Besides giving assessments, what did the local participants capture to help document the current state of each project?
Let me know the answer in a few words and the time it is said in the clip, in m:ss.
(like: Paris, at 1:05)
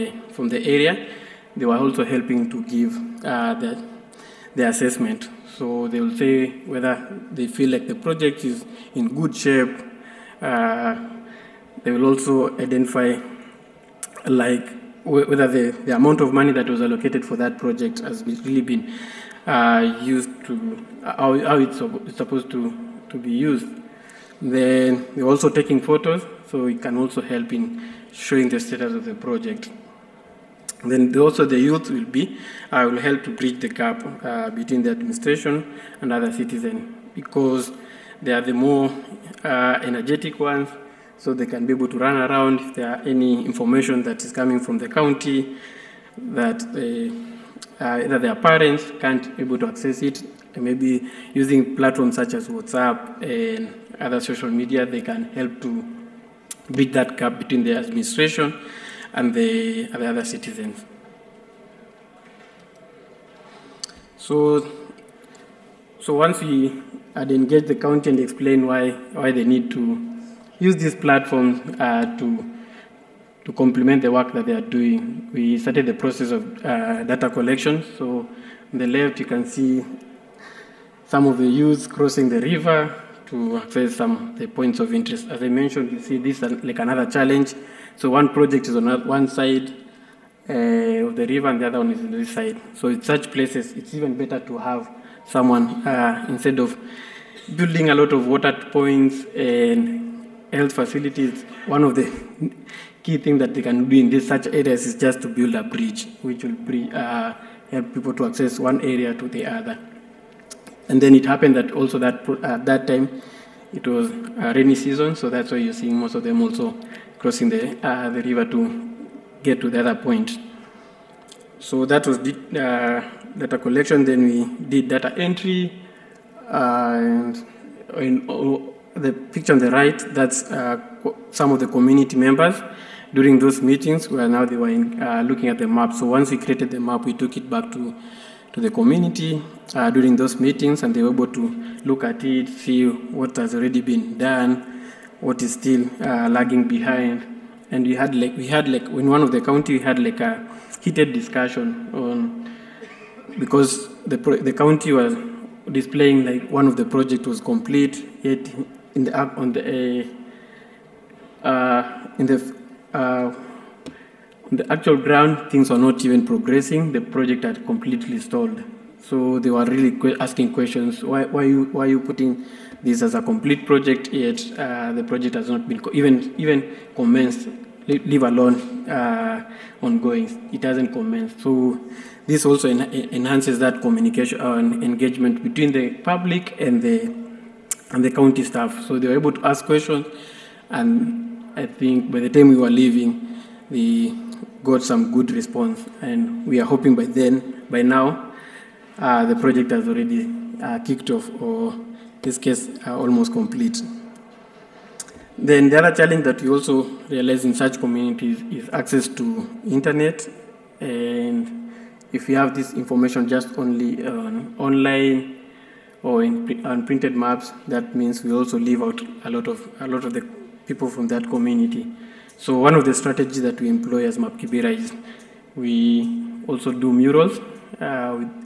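photos, at 0:25.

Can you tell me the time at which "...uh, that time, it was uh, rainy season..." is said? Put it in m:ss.
1:52.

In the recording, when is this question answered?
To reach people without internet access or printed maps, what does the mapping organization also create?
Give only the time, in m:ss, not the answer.
3:46.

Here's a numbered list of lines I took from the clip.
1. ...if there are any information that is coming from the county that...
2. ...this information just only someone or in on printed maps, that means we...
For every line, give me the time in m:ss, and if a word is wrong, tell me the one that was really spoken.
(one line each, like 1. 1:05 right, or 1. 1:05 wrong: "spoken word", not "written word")
1. 0:42 right
2. 3:32 wrong: "online", not "someone".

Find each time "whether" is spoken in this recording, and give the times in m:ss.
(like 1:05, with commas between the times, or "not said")
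0:06, 0:15.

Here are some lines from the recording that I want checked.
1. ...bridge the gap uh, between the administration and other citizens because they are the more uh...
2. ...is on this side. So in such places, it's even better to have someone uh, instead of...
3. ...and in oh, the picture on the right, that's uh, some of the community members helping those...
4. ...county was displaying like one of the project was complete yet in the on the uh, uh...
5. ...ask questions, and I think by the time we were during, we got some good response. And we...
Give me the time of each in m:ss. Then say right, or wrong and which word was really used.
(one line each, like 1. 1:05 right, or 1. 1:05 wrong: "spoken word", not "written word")
1. 0:33 right
2. 1:31 right
3. 2:06 wrong: "during", not "helping"
4. 2:34 right
5. 3:09 wrong: "leaving", not "during".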